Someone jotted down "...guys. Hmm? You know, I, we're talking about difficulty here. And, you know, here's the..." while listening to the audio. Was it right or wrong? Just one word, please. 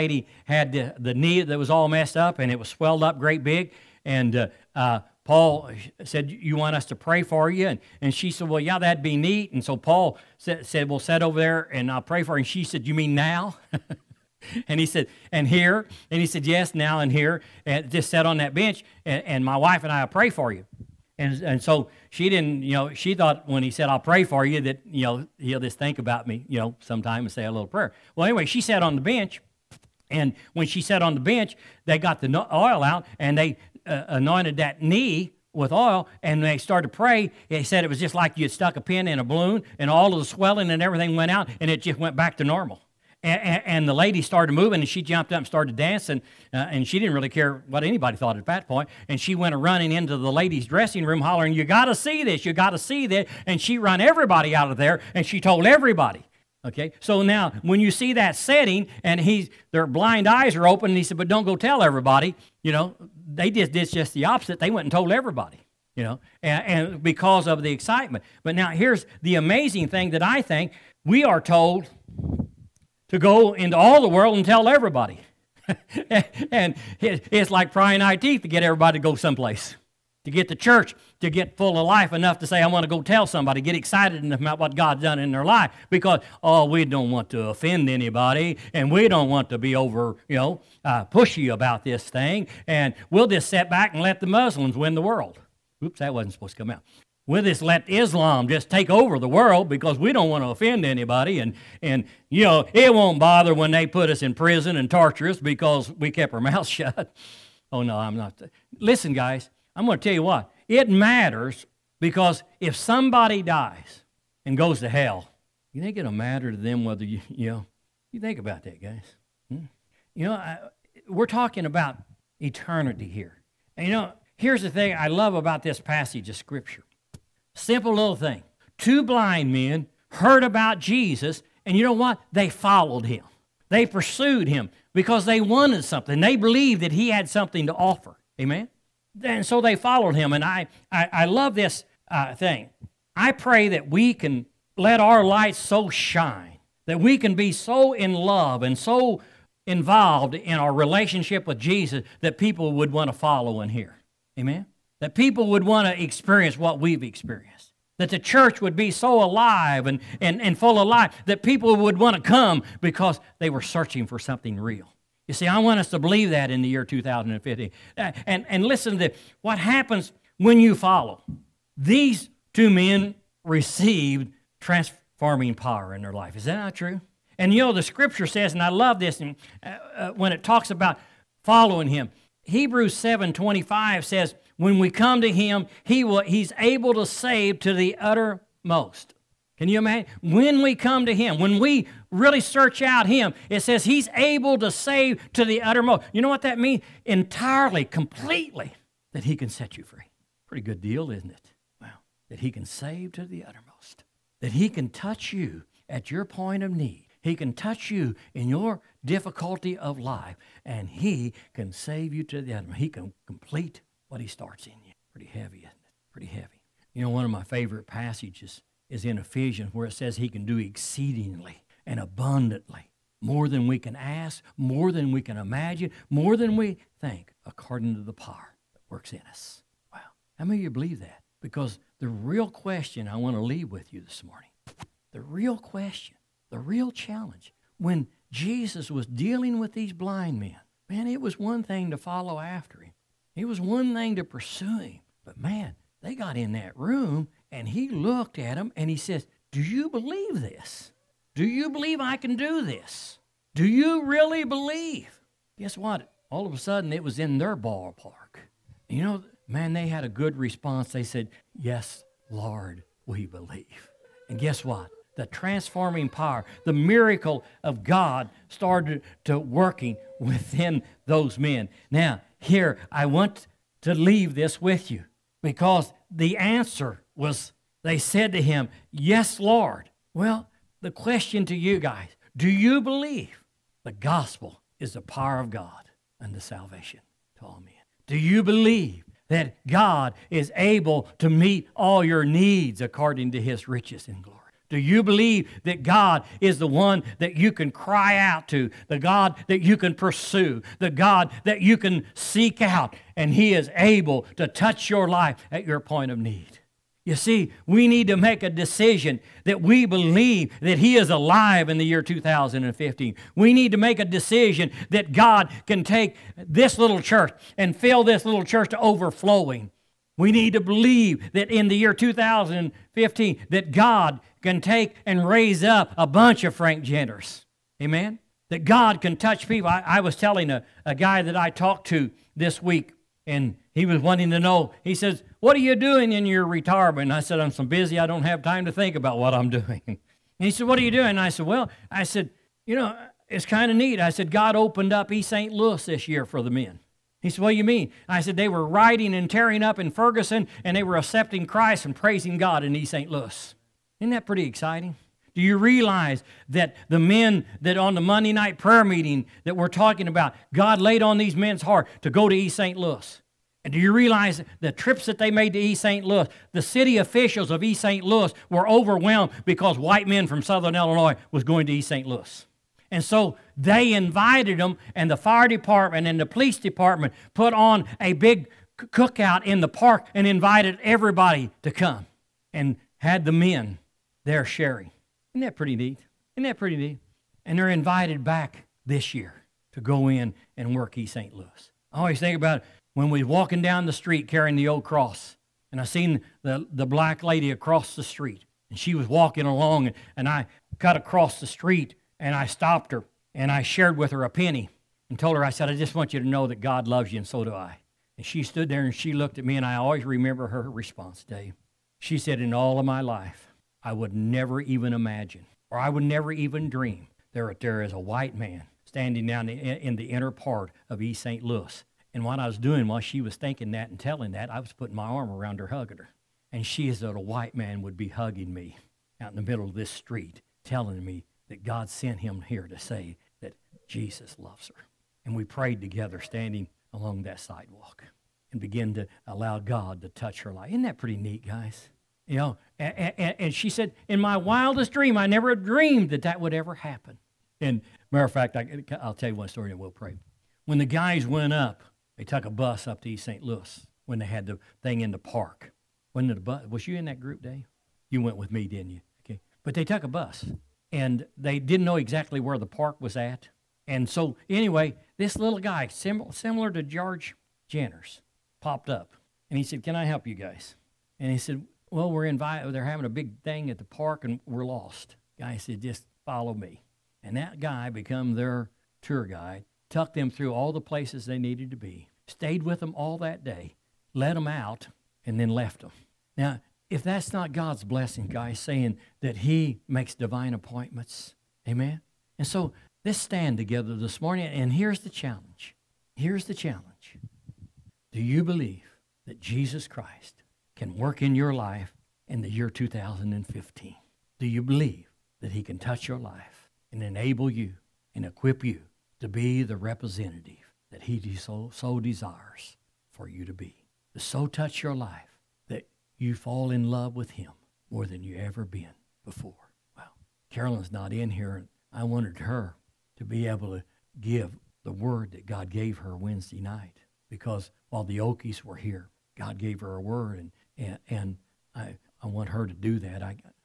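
wrong.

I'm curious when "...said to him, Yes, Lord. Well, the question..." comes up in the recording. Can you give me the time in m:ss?
4:37.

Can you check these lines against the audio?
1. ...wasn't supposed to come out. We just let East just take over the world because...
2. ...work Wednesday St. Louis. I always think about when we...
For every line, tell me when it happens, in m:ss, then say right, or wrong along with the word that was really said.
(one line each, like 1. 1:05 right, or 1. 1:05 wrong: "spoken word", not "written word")
1. 1:36 wrong: "Islam", not "East"
2. 6:30 wrong: "East", not "Wednesday".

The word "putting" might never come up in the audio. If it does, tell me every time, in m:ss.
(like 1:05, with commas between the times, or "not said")
7:04.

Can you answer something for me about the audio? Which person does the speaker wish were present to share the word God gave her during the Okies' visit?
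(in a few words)
Carolyn.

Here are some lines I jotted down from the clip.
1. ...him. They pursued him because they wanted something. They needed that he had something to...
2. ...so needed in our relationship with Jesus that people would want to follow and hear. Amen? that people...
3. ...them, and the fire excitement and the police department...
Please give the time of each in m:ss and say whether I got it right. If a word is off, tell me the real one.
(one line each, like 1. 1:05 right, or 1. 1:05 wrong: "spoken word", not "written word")
1. 2:13 wrong: "believed", not "needed"
2. 2:28 wrong: "involved", not "needed"
3. 6:14 wrong: "department", not "excitement".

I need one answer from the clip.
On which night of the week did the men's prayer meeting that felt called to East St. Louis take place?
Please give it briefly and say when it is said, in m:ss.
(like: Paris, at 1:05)
Monday, at 5:58.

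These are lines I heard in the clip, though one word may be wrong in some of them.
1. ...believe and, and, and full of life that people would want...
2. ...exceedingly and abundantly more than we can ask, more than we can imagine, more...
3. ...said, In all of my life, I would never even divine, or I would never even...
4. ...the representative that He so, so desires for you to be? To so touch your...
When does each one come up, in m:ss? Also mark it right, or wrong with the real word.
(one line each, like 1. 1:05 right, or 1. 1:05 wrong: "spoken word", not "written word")
1. 2:39 wrong: "alive", not "believe"
2. 3:40 right
3. 6:52 wrong: "imagine", not "divine"
4. 8:29 right.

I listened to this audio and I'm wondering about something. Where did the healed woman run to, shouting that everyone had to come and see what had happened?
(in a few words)
ladies dressing room.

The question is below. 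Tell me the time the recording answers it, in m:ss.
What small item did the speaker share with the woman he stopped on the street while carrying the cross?
6:44.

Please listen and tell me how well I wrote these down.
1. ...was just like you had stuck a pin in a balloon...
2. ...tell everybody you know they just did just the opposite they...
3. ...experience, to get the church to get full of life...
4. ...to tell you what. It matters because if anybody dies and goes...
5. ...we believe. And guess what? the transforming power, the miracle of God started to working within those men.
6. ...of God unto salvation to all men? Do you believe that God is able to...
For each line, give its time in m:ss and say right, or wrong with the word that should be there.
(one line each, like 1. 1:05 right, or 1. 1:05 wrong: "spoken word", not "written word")
1. 0:37 right
2. 1:01 right
3. 1:19 wrong: "someplace", not "experience"
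4. 1:49 wrong: "somebody", not "anybody"
5. 4:23 right
6. 4:45 right.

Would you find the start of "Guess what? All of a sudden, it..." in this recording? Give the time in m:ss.
4:15.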